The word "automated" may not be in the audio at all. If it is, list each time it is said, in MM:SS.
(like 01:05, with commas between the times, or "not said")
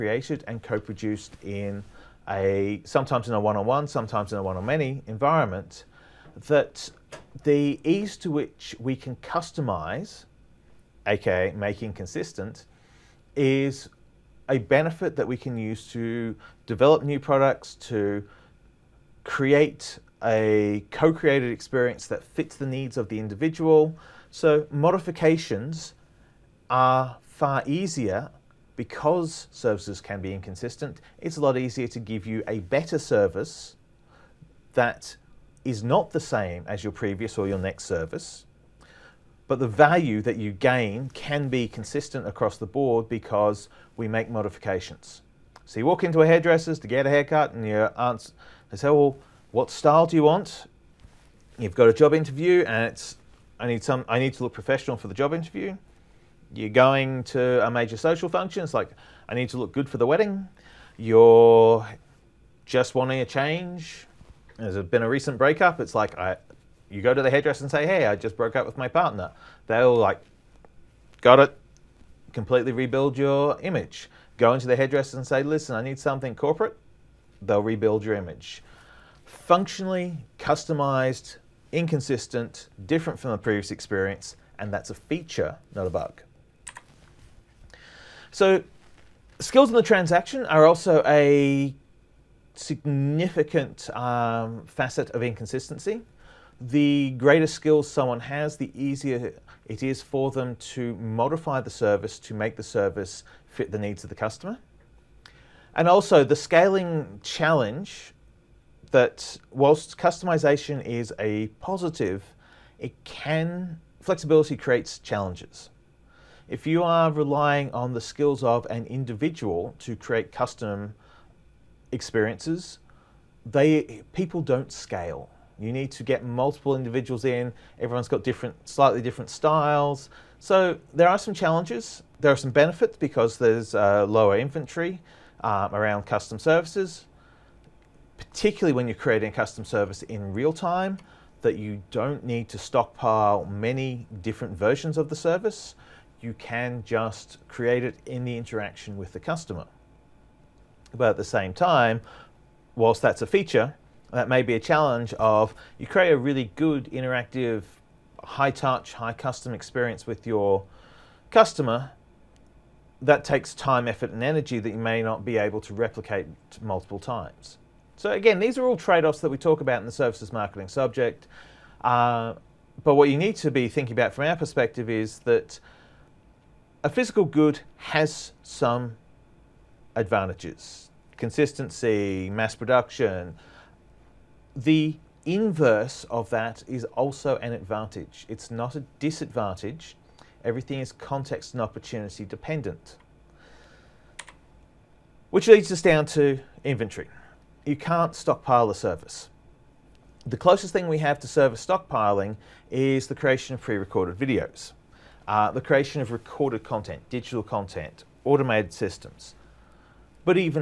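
03:28.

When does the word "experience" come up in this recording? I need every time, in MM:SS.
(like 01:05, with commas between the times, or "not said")
00:21, 01:23, 02:01, 02:39.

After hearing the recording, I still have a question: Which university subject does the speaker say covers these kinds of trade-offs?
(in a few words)
services marketing.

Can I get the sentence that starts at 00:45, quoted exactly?
So you walk into a hairdresser's to get a haircut and you aunt's they say, well, what style do you want?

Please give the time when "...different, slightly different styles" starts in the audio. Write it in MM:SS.
02:08.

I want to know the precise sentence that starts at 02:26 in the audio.
You can just create it in the interaction with the customer.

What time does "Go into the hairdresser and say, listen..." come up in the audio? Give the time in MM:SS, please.
01:14.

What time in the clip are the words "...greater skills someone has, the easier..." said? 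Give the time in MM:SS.
01:37.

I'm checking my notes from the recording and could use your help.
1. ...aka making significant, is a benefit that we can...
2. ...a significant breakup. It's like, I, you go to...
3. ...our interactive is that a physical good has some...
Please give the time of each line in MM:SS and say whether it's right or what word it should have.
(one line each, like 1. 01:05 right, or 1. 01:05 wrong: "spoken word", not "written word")
1. 00:11 wrong: "consistent", not "significant"
2. 01:05 wrong: "recent", not "significant"
3. 02:54 wrong: "perspective", not "interactive".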